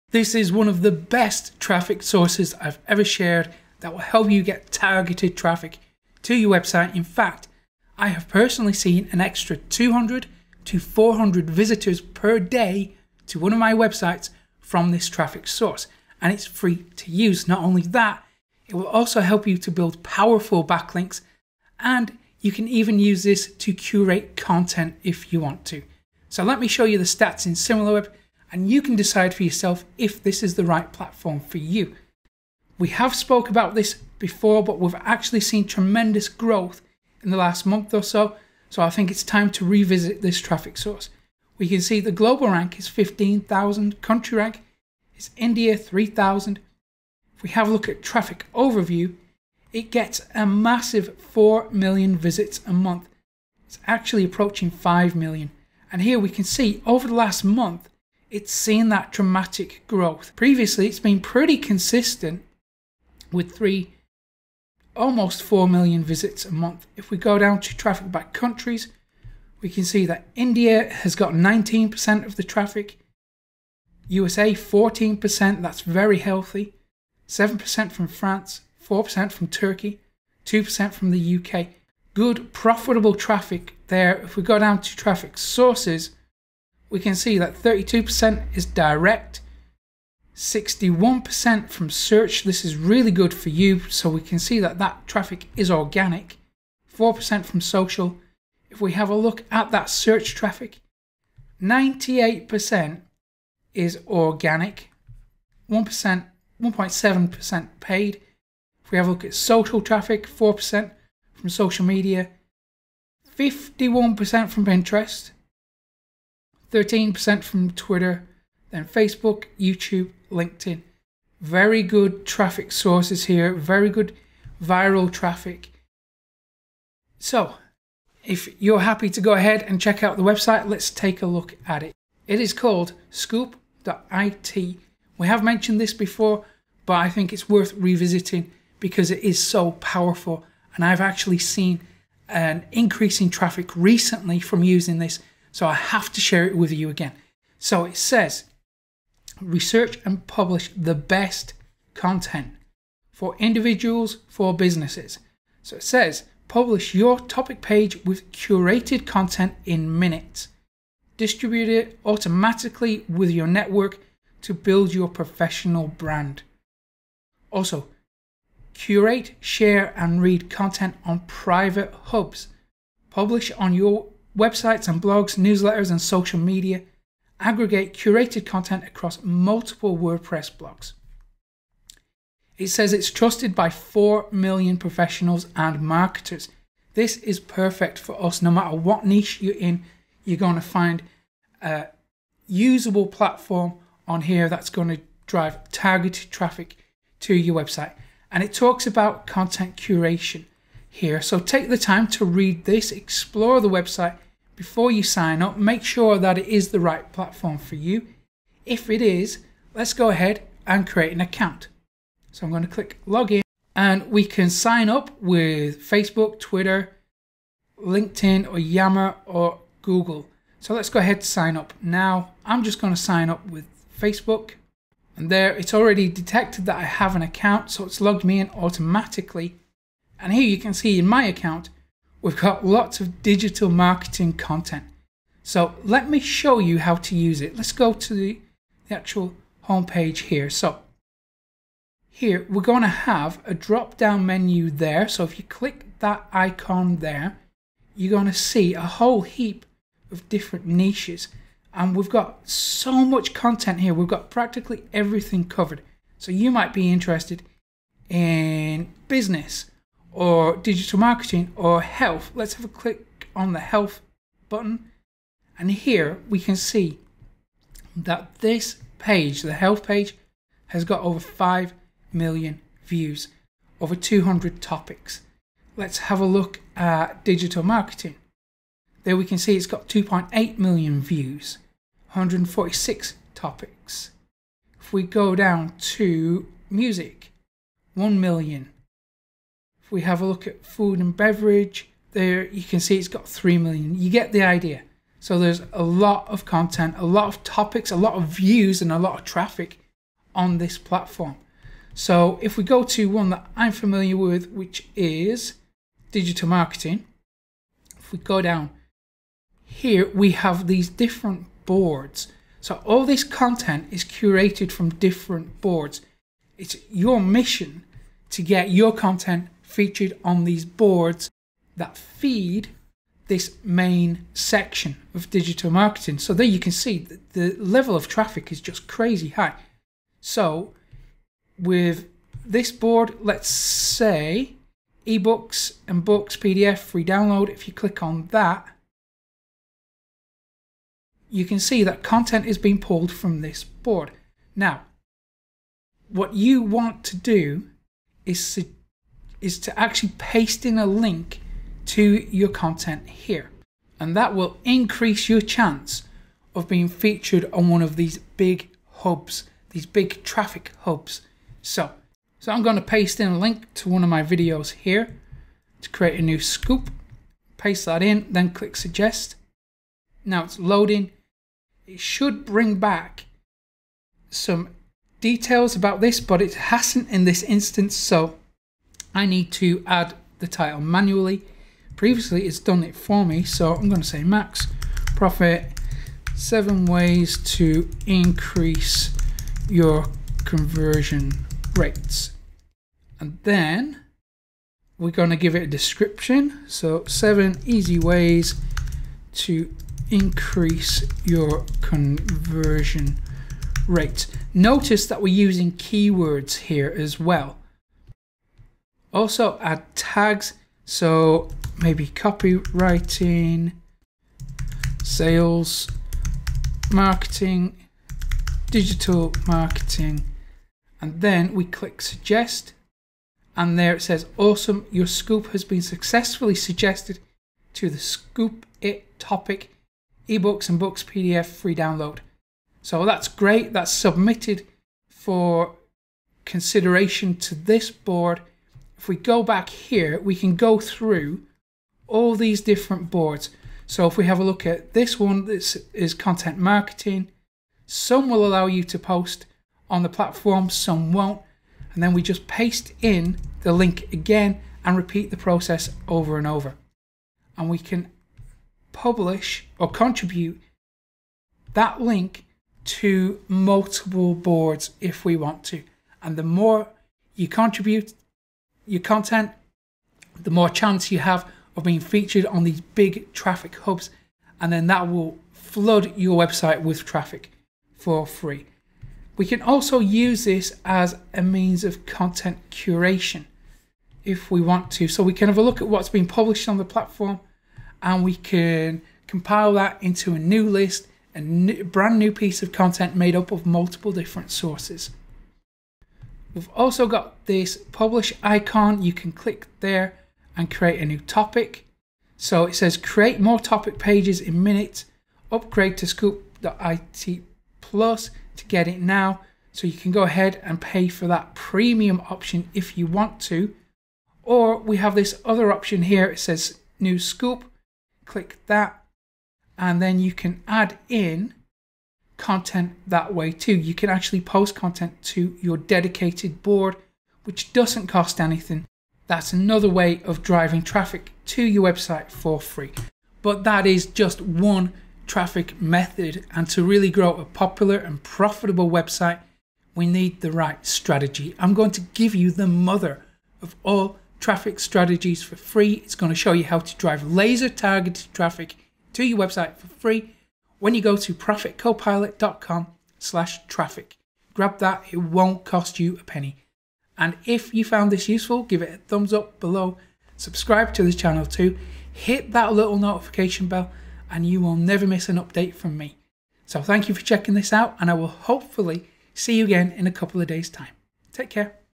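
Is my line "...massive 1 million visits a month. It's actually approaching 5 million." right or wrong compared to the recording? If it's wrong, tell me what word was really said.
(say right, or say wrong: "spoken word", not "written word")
wrong: "4", not "1".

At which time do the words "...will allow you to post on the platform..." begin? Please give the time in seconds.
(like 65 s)
448 s.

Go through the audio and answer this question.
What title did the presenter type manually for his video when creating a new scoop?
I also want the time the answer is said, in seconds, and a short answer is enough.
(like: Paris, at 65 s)
Max Profit, at 384 s.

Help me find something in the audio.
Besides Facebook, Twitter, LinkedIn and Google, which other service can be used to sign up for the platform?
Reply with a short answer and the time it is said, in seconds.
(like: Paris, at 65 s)
Yammer, at 218 s.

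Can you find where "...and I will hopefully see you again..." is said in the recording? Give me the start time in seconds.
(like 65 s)
567 s.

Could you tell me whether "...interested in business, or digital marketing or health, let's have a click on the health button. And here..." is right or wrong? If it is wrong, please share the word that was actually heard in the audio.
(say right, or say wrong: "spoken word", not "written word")
right.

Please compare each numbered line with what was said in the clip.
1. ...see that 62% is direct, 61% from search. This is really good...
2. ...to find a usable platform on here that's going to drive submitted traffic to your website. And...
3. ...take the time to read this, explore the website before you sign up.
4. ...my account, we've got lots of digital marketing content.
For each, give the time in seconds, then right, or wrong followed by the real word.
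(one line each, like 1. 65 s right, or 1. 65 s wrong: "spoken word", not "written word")
1. 87 s wrong: "32", not "62"
2. 190 s wrong: "targeted", not "submitted"
3. 201 s right
4. 231 s right.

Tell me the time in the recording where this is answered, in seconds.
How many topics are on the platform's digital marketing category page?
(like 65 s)
282 s.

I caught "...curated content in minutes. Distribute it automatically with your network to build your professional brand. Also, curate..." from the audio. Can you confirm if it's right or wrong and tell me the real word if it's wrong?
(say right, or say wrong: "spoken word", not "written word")
right.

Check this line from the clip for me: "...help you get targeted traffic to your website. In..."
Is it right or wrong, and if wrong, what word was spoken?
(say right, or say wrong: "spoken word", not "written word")
right.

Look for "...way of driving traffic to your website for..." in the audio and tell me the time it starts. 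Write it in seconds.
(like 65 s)
529 s.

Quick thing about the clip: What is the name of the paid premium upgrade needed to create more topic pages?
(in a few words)
Scoop.it Plus.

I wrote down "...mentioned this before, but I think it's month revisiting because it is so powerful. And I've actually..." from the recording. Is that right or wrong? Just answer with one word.
wrong.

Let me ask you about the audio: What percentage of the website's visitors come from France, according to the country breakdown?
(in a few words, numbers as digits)
7%.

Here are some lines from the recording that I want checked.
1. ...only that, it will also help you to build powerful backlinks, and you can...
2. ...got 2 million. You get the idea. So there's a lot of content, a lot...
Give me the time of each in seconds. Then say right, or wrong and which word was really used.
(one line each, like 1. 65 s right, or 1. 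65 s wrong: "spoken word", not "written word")
1. 17 s right
2. 293 s wrong: "3", not "2".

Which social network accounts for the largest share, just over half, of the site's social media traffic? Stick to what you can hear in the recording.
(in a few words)
Pinterest.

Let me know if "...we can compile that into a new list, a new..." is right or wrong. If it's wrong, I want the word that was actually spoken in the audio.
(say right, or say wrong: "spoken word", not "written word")
right.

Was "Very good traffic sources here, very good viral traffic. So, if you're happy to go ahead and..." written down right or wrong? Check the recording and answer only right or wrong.
right.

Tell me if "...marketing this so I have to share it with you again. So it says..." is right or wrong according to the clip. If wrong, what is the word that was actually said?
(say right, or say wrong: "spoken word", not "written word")
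wrong: "using", not "marketing".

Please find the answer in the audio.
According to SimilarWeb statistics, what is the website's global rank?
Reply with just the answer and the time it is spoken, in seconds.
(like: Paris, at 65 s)
15,000, at 42 s.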